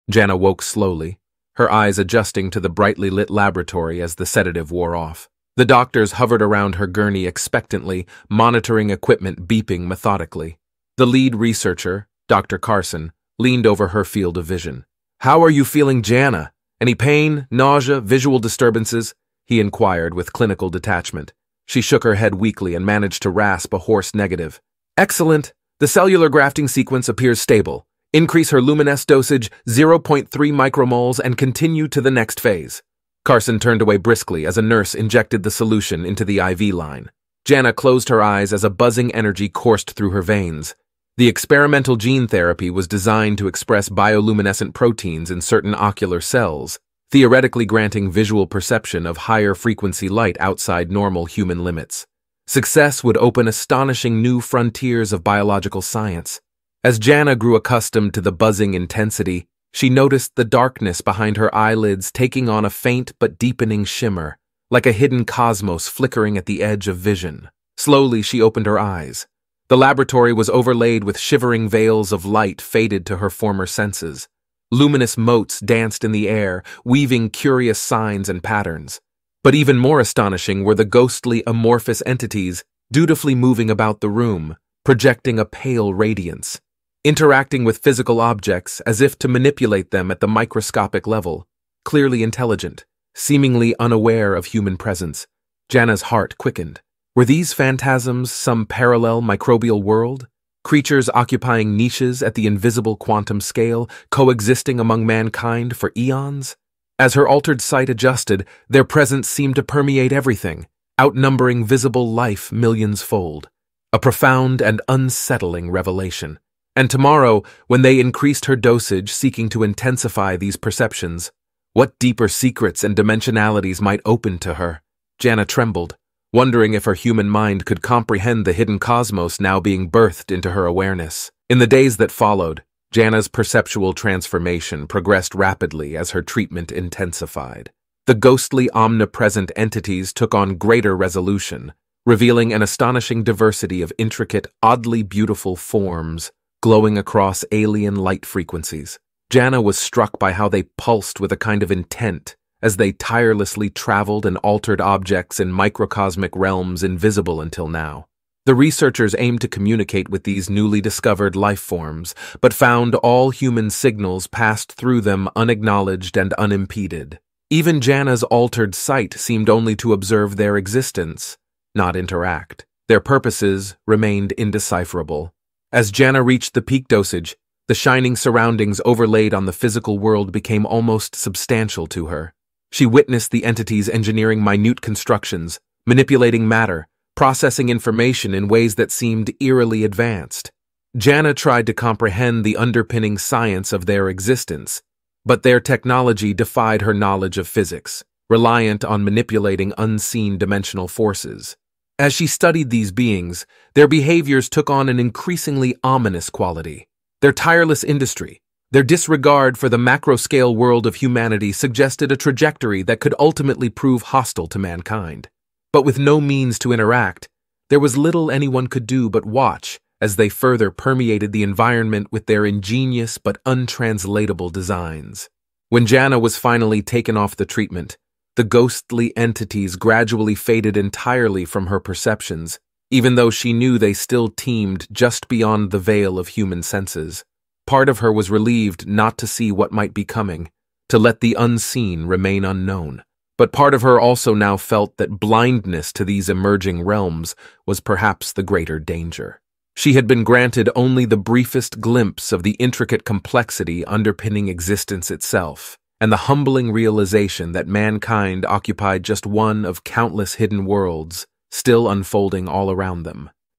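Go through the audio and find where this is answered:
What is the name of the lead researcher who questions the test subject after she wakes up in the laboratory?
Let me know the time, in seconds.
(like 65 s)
12 s.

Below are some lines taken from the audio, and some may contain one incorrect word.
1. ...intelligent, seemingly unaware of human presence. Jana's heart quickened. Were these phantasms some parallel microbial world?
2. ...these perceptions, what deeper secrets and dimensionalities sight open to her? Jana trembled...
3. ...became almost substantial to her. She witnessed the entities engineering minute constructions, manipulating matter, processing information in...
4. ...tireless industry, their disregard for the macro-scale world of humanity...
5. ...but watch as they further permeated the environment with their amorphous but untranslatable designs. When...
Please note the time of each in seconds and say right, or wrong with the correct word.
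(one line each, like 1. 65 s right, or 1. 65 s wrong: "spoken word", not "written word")
1. 92 s right
2. 120 s wrong: "might", not "sight"
3. 180 s right
4. 207 s right
5. 219 s wrong: "ingenious", not "amorphous".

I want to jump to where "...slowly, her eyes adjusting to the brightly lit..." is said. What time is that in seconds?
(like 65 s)
0 s.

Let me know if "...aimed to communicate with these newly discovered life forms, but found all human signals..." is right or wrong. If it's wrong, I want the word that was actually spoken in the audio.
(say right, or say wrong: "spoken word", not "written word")
right.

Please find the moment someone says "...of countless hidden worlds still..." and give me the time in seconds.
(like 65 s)
259 s.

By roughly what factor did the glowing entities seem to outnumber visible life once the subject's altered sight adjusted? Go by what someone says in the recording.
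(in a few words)
millions fold.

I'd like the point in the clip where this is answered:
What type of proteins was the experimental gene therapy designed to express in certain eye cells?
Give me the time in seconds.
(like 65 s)
43 s.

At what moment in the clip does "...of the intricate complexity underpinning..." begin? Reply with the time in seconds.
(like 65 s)
252 s.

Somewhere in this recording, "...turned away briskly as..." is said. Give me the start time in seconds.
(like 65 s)
33 s.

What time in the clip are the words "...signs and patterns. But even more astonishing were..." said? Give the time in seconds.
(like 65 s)
77 s.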